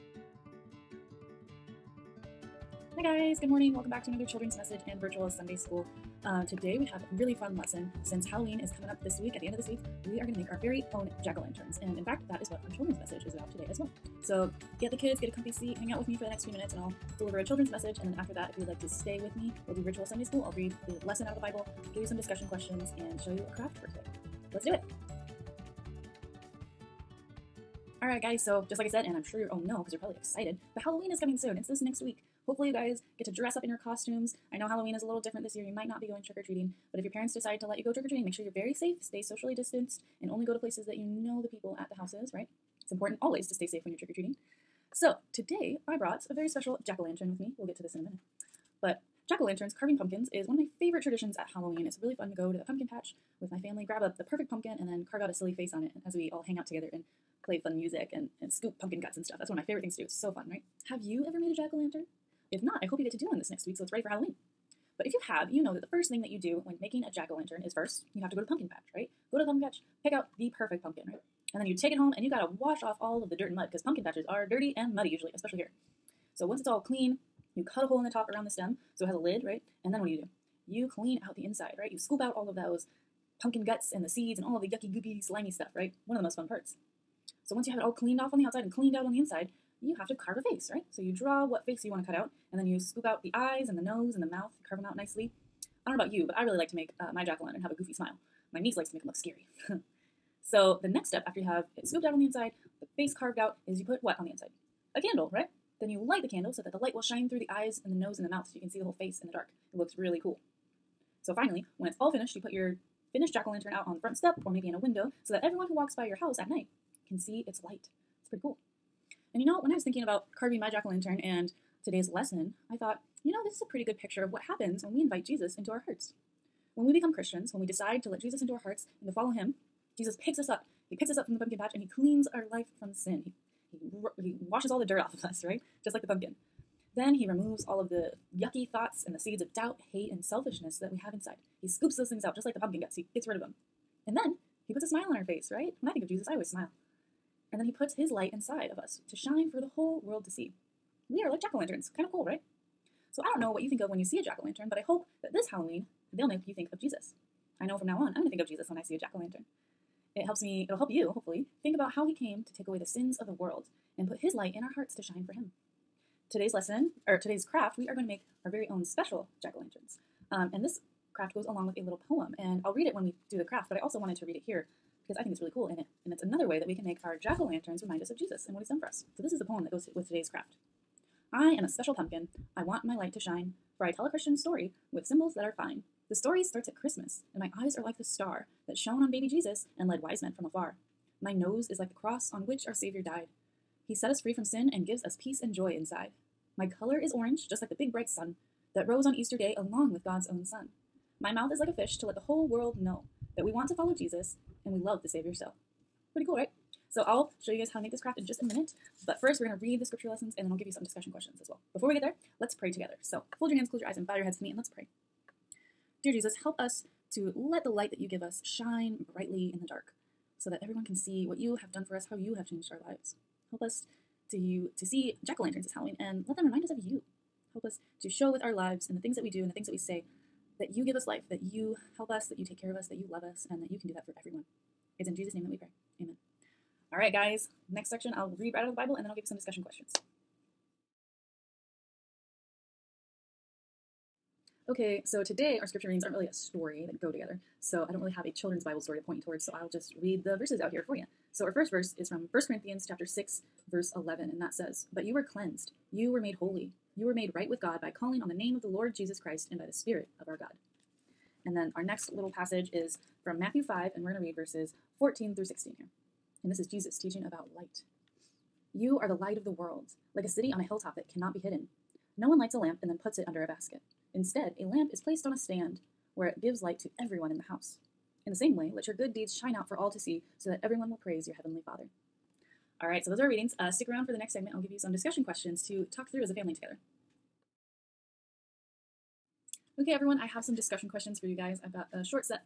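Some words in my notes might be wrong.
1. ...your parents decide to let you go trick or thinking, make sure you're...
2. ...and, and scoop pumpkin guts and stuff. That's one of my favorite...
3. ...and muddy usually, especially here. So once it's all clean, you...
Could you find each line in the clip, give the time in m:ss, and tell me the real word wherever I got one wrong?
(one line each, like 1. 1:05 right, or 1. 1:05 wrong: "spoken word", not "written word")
1. 0:37 wrong: "treating", not "thinking"
2. 0:58 right
3. 1:14 right.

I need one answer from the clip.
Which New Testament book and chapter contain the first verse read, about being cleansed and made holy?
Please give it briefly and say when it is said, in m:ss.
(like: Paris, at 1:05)
1 Corinthians 6, at 4:12.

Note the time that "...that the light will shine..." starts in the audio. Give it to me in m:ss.
1:46.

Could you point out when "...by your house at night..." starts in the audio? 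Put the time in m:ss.
1:55.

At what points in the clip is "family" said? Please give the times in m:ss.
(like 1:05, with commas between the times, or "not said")
0:53, 4:46.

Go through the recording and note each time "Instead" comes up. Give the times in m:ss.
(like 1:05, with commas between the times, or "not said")
4:34.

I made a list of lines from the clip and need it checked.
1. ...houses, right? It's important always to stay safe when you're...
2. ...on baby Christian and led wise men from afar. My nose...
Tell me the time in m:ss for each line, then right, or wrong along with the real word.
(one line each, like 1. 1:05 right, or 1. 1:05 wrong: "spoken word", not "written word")
1. 0:42 right
2. 3:09 wrong: "Jesus", not "Christian".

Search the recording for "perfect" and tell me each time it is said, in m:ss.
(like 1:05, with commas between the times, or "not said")
0:54, 1:10.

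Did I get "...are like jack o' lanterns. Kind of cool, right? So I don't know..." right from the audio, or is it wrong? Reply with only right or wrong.
right.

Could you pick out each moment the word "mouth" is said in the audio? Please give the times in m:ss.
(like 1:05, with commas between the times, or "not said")
1:34, 1:48, 3:21.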